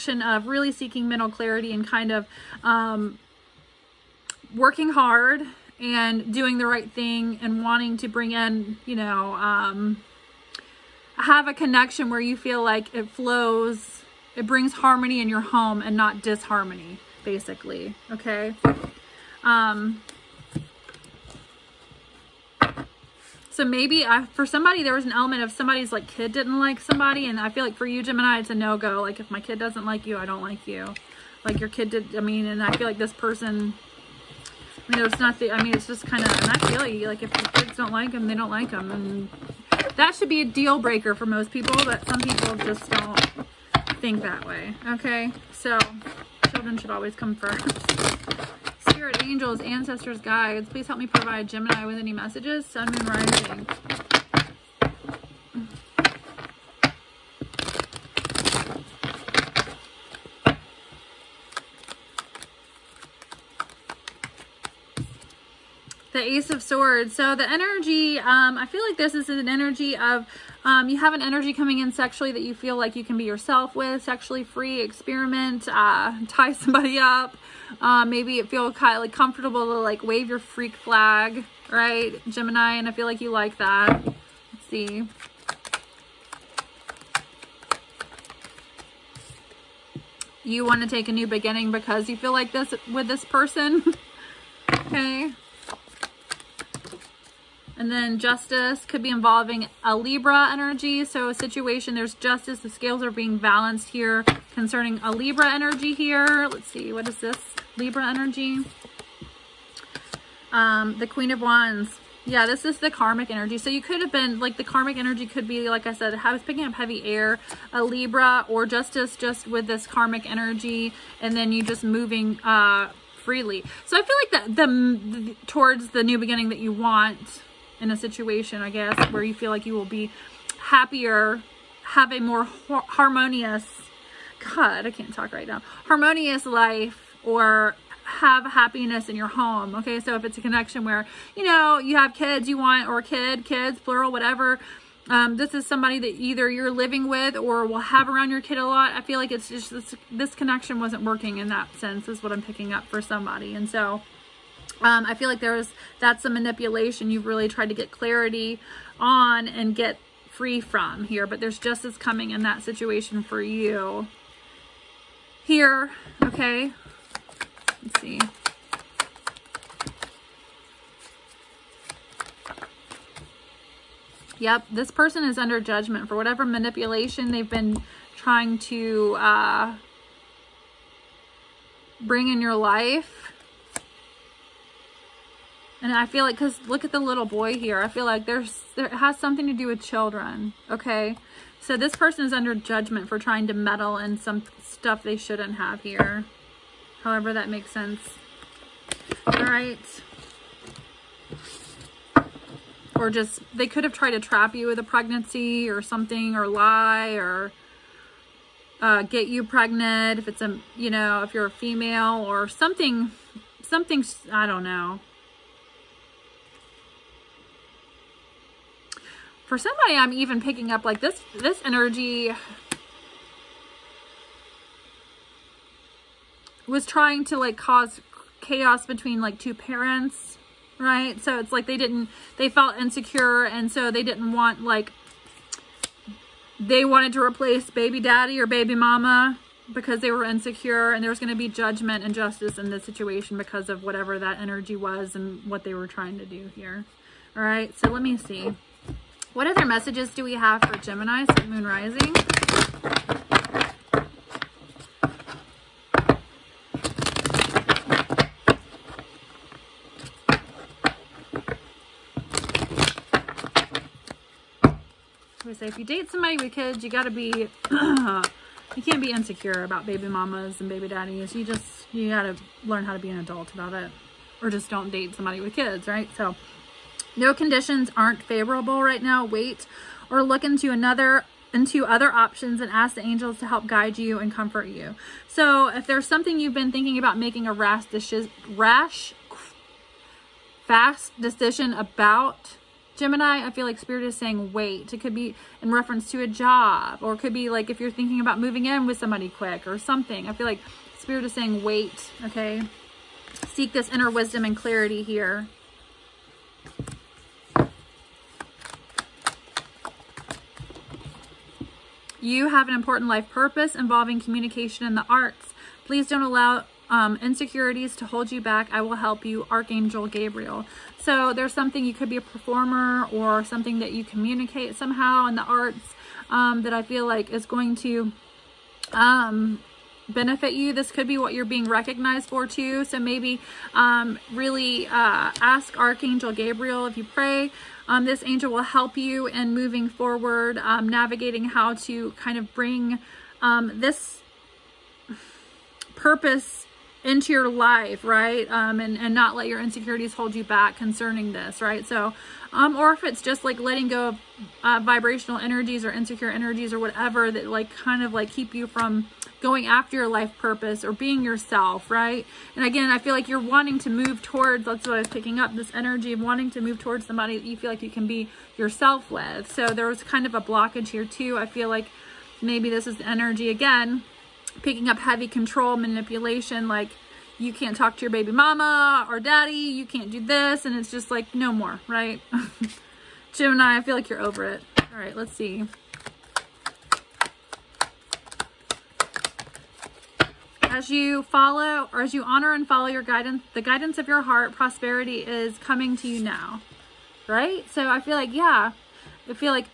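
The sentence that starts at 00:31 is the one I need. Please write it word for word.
Like your kid did, I mean, and I feel like this person, I mean, not the.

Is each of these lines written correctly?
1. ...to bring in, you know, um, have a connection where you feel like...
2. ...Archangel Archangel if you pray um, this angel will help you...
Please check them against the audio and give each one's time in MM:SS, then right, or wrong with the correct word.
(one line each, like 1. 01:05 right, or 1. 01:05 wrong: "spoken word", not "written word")
1. 00:07 right
2. 05:35 wrong: "Gabriel", not "Archangel".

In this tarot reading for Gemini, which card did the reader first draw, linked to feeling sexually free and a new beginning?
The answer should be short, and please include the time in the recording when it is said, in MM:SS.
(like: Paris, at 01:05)
Ace of Swords, at 01:06.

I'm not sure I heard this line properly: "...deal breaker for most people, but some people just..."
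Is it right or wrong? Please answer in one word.
right.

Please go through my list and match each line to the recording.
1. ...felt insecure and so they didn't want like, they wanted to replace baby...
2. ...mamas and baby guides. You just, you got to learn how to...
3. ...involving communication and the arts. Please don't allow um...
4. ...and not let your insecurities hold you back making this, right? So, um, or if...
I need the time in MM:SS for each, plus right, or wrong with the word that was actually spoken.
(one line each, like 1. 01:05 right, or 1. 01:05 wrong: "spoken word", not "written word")
1. 03:52 right
2. 04:30 wrong: "daddies", not "guides"
3. 05:13 right
4. 05:48 wrong: "concerning", not "making".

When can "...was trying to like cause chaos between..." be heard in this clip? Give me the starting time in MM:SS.
03:46.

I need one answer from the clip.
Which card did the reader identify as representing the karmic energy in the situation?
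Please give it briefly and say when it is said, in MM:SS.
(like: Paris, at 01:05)
Queen of Wands, at 01:50.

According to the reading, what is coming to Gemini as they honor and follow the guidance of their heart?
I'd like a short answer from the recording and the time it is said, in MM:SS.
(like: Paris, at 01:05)
Prosperity, at 06:34.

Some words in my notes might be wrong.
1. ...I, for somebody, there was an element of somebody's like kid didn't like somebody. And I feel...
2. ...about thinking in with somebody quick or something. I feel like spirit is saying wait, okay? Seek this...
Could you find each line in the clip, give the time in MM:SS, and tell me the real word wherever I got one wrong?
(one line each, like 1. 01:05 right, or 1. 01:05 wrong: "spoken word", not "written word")
1. 00:24 right
2. 04:58 wrong: "moving", not "thinking".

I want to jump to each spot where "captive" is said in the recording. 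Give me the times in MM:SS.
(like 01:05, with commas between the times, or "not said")
not said.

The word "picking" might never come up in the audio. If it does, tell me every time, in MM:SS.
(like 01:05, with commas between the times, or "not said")
01:56, 02:32, 03:40, 06:05, 06:14.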